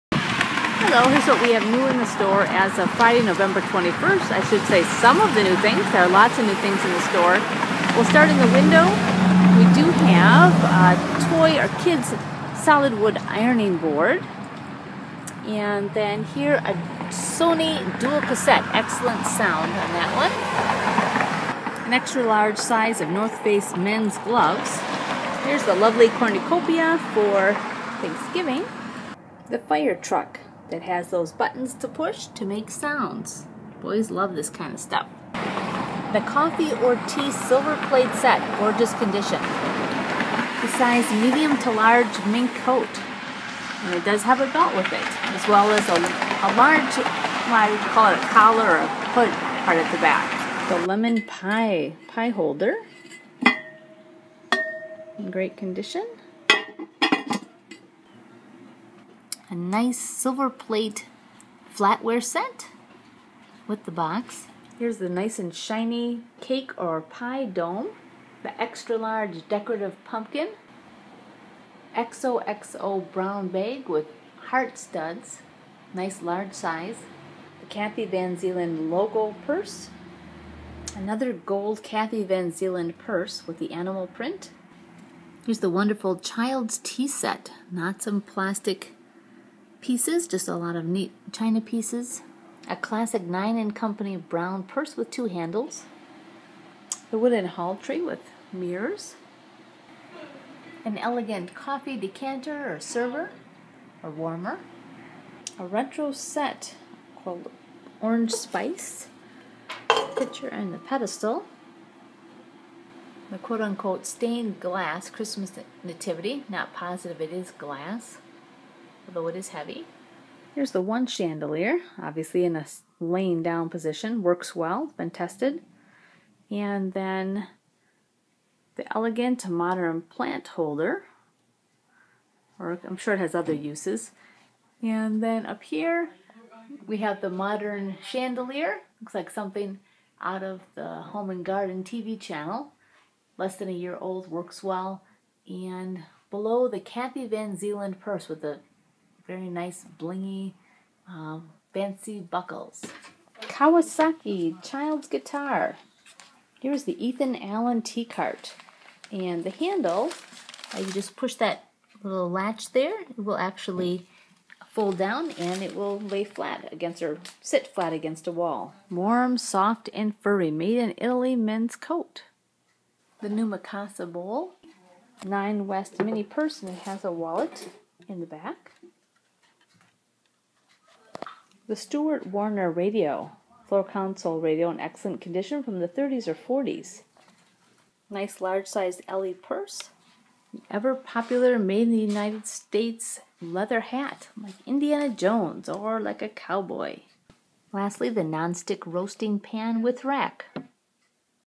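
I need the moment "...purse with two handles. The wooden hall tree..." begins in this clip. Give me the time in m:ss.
1:34.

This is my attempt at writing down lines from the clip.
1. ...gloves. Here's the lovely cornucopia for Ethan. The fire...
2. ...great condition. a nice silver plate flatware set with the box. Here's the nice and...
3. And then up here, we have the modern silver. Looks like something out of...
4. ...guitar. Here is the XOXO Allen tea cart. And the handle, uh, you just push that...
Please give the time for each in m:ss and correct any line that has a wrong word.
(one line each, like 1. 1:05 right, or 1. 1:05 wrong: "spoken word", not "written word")
1. 0:24 wrong: "Thanksgiving", not "Ethan"
2. 0:55 right
3. 2:14 wrong: "chandelier", not "silver"
4. 2:35 wrong: "Ethan", not "XOXO".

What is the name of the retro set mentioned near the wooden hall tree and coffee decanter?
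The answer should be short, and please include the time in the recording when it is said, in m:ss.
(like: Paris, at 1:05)
Orange Spice, at 1:47.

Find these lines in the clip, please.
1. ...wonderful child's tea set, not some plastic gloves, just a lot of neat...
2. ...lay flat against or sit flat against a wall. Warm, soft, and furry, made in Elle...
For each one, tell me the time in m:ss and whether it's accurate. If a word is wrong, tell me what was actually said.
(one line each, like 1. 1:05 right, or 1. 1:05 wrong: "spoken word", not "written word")
1. 1:25 wrong: "pieces", not "gloves"
2. 2:45 wrong: "Italy", not "Elle".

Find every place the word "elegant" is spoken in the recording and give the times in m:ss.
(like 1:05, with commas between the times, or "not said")
1:40, 2:08.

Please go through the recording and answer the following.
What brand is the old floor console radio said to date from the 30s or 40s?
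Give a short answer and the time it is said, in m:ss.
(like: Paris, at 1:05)
Stewart Warner, at 3:01.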